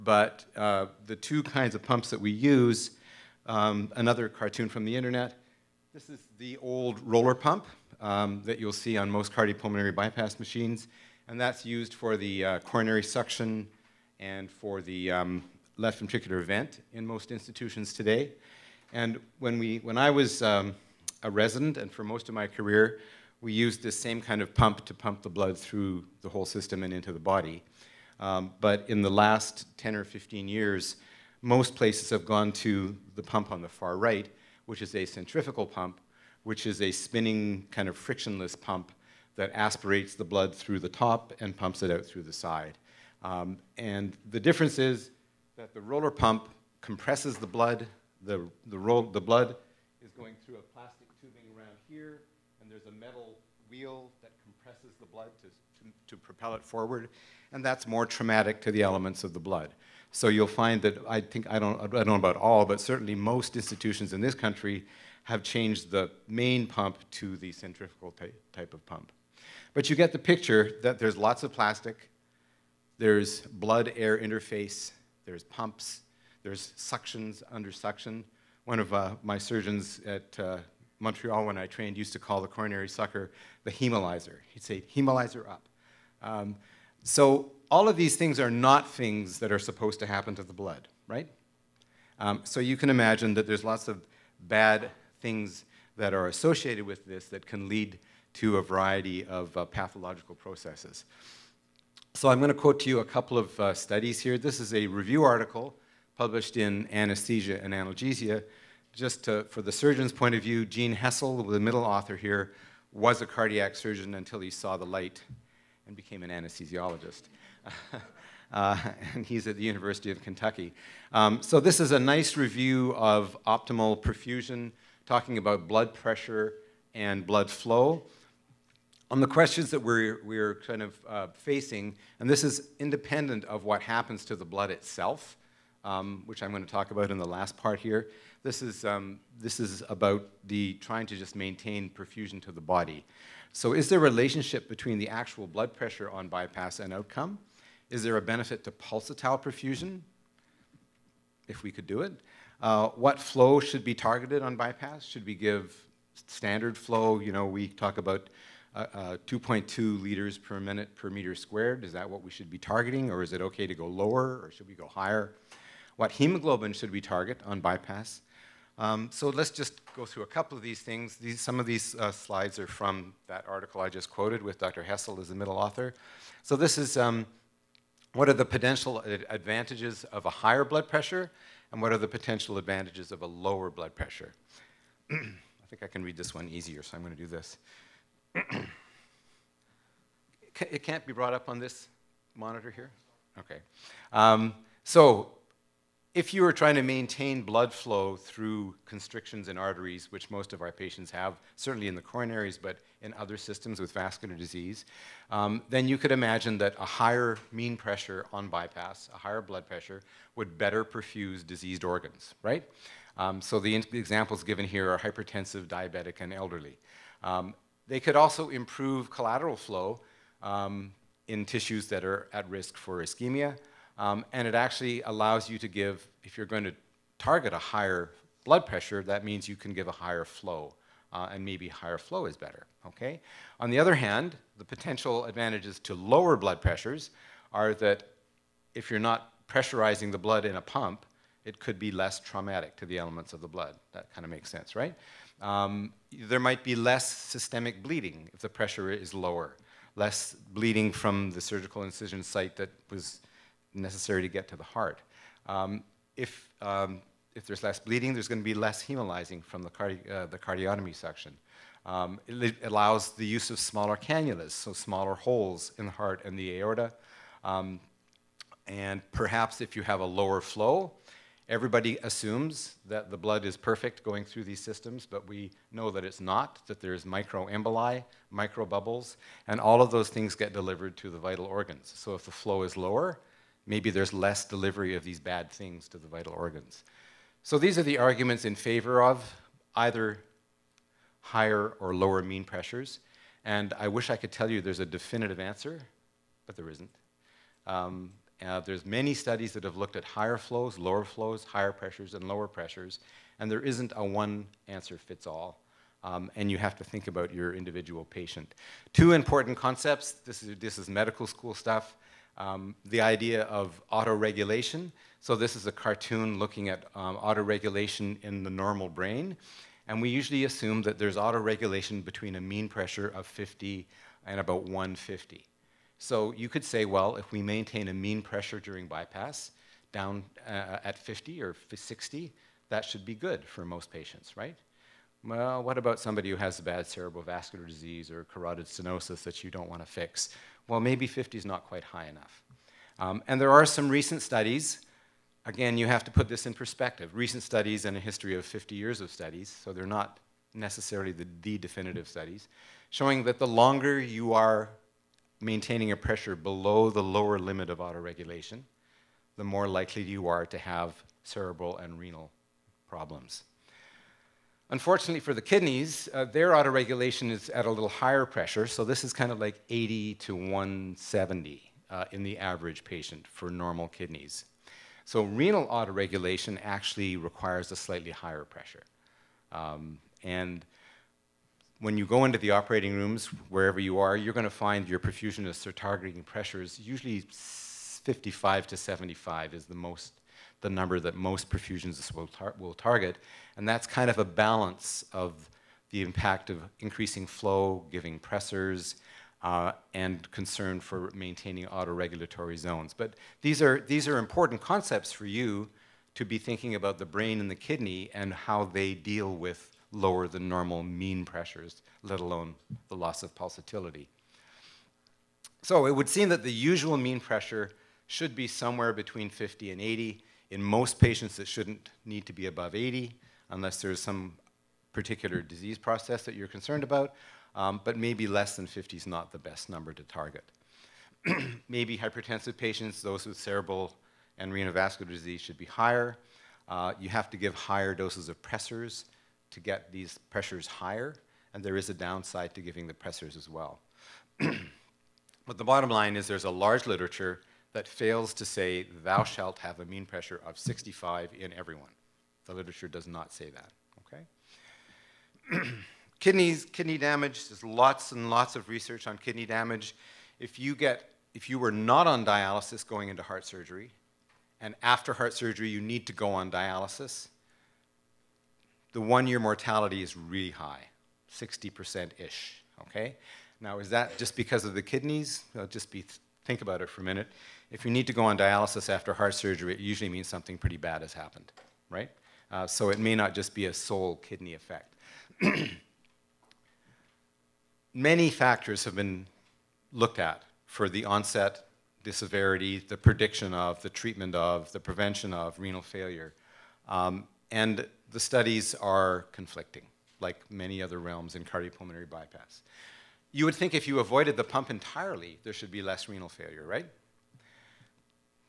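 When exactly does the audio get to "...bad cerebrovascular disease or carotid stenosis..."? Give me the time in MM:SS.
05:36.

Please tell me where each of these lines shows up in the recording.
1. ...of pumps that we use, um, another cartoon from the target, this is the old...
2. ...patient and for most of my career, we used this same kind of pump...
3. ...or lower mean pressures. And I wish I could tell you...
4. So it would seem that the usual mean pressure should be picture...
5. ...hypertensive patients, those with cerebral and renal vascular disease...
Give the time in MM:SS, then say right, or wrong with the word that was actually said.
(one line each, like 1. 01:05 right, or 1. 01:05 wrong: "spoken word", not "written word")
1. 00:01 wrong: "internet", not "target"
2. 00:21 wrong: "resident", not "patient"
3. 04:51 right
4. 06:55 wrong: "somewhere", not "picture"
5. 07:11 right.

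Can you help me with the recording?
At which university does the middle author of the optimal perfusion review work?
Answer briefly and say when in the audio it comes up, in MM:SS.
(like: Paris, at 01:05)
University of Kentucky, at 01:59.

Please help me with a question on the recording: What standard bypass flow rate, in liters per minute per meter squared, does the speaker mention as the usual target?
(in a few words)
2.2.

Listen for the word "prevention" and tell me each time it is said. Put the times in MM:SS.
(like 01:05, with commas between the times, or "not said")
08:14.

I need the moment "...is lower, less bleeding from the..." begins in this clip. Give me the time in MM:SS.
04:08.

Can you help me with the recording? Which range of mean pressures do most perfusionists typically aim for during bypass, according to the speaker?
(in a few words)
55 to 75.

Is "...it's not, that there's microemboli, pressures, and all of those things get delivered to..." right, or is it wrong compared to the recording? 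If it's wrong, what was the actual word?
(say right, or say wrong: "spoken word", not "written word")
wrong: "microbubbles", not "pressures".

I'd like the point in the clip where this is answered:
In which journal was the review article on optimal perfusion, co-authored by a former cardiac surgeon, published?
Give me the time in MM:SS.
01:46.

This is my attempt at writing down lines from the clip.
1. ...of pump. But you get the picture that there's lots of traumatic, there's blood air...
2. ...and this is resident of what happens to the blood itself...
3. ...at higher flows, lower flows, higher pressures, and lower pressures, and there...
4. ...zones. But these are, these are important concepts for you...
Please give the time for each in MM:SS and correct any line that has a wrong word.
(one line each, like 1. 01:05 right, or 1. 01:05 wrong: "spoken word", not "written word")
1. 01:08 wrong: "plastic", not "traumatic"
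2. 02:12 wrong: "independent", not "resident"
3. 04:59 right
4. 06:42 right.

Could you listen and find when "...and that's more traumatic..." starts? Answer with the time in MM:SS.
00:57.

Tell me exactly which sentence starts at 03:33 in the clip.
Um, so the, the, examples given here are hypertensive, diabetic, and elderly.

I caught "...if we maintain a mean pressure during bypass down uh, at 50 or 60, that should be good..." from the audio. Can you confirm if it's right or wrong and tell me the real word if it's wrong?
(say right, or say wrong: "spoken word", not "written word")
right.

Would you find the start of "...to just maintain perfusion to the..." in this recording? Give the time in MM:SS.
02:21.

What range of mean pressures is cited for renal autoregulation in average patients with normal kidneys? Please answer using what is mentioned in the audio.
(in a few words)
80 to 170.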